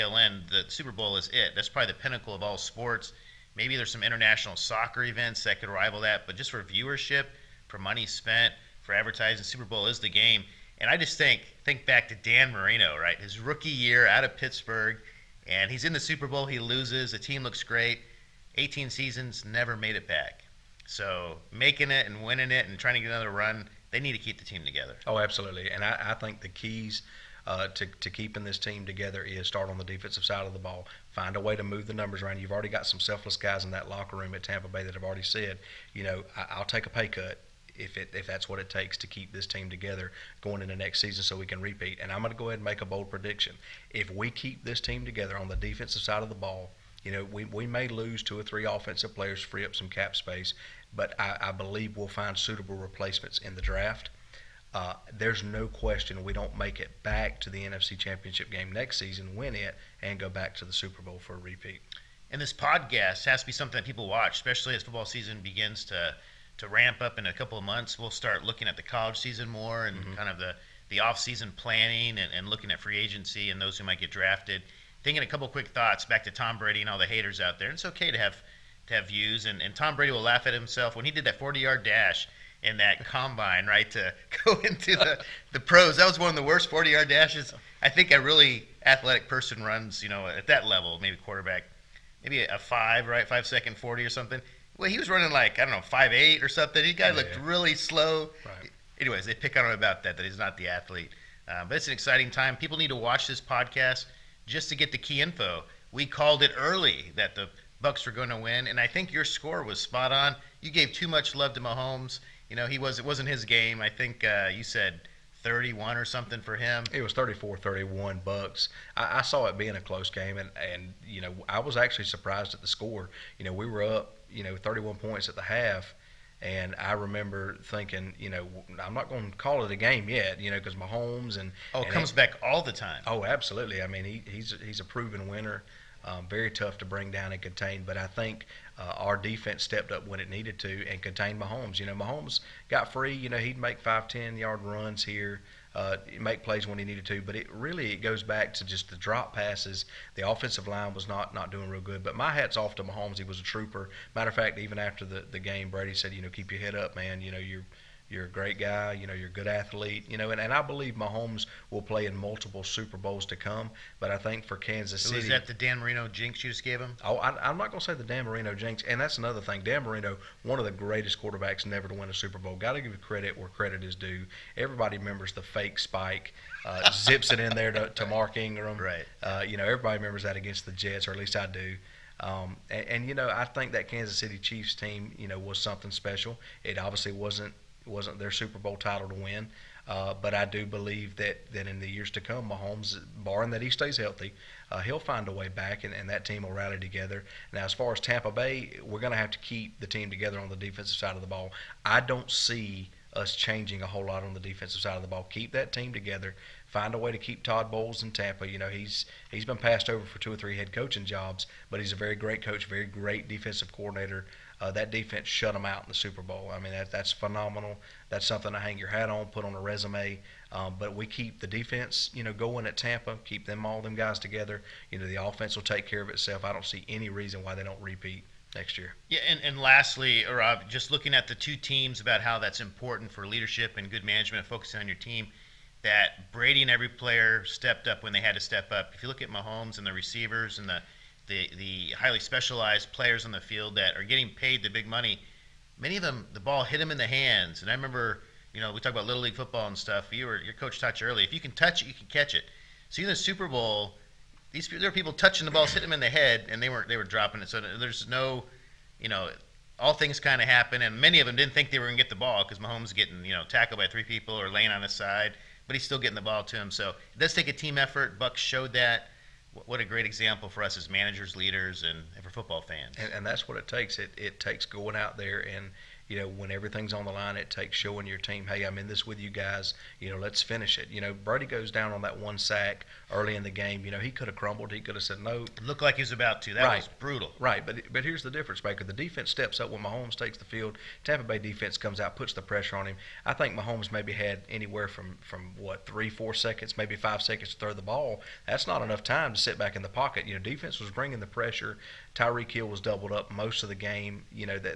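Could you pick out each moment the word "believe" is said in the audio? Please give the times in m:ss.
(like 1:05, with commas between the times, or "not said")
0:51, 2:40, 3:10.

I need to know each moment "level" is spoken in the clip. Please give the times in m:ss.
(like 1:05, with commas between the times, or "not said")
1:30.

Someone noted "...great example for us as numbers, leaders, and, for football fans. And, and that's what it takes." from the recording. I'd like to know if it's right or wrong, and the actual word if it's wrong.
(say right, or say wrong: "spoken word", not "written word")
wrong: "managers", not "numbers".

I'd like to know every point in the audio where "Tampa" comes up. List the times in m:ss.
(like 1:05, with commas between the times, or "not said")
0:34, 3:18, 3:28, 3:42, 4:51.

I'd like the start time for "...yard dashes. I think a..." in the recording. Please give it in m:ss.
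1:26.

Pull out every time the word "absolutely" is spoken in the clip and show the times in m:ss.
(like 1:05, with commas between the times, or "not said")
0:25, 2:13.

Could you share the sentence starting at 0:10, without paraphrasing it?
And I just think think back to Dan Marino, right?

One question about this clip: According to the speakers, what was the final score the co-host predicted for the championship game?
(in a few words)
34-31.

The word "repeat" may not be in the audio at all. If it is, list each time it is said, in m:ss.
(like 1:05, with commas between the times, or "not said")
0:41, 1:01, 3:47.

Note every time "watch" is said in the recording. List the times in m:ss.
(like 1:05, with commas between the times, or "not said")
1:04, 1:42.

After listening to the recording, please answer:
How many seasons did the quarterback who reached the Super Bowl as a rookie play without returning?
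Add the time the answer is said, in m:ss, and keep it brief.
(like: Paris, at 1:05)
18, at 0:18.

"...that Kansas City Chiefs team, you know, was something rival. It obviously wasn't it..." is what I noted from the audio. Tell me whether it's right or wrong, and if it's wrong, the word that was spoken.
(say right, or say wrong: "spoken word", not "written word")
wrong: "special", not "rival".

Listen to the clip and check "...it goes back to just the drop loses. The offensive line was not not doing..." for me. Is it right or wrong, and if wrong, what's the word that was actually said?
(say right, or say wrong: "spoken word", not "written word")
wrong: "passes", not "loses".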